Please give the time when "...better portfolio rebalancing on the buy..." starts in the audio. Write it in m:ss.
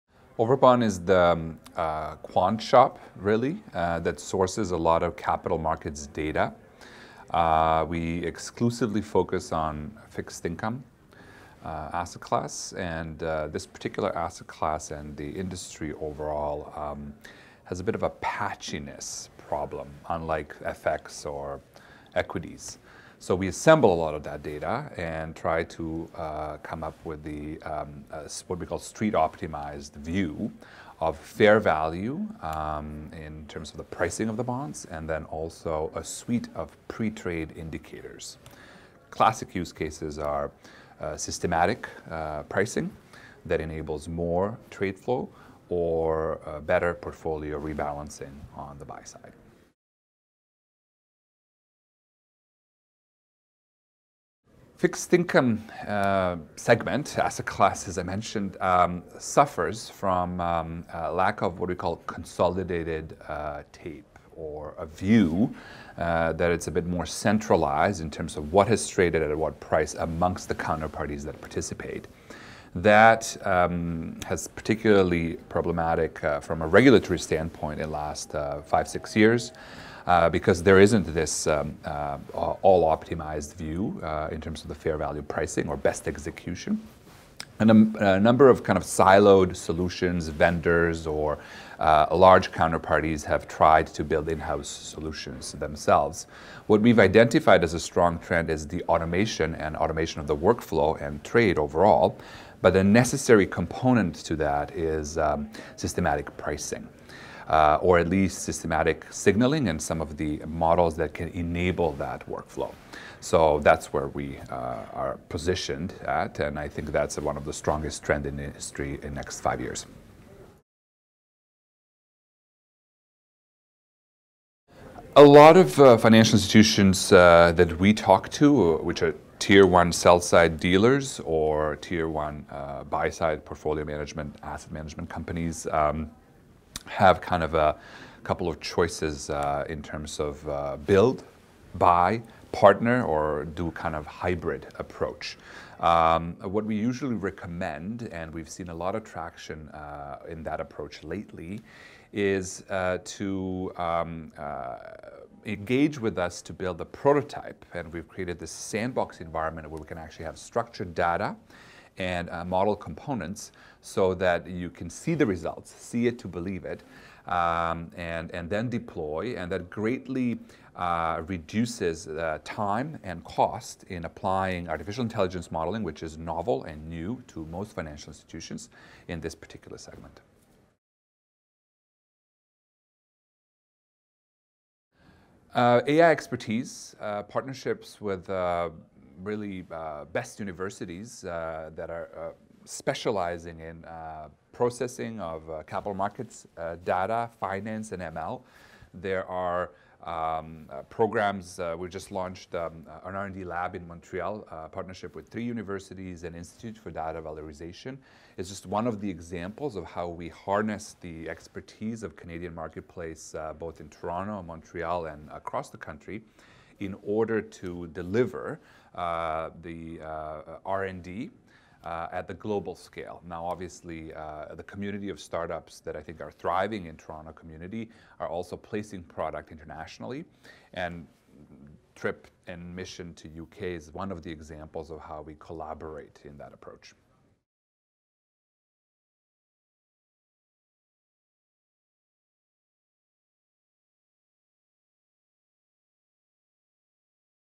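0:46.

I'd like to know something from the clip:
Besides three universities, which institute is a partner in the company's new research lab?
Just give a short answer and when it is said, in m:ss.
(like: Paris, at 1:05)
Institute for Data Valorization, at 3:26.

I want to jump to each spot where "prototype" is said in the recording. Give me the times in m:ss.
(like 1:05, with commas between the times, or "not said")
2:36.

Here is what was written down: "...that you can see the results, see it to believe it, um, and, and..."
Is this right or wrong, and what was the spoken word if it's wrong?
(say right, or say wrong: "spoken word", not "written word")
right.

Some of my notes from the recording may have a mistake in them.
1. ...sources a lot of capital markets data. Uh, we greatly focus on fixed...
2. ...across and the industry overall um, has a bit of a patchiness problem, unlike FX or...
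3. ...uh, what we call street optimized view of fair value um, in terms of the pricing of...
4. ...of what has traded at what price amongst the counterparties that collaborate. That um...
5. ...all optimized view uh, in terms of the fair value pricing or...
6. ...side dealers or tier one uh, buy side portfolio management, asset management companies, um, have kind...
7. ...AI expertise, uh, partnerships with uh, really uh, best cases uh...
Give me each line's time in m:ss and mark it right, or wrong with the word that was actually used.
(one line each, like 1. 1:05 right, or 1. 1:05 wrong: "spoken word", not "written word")
1. 0:04 wrong: "exclusively", not "greatly"
2. 0:14 wrong: "class", not "across"
3. 0:28 right
4. 1:08 wrong: "participate", not "collaborate"
5. 1:22 right
6. 2:10 right
7. 3:05 wrong: "universities", not "cases".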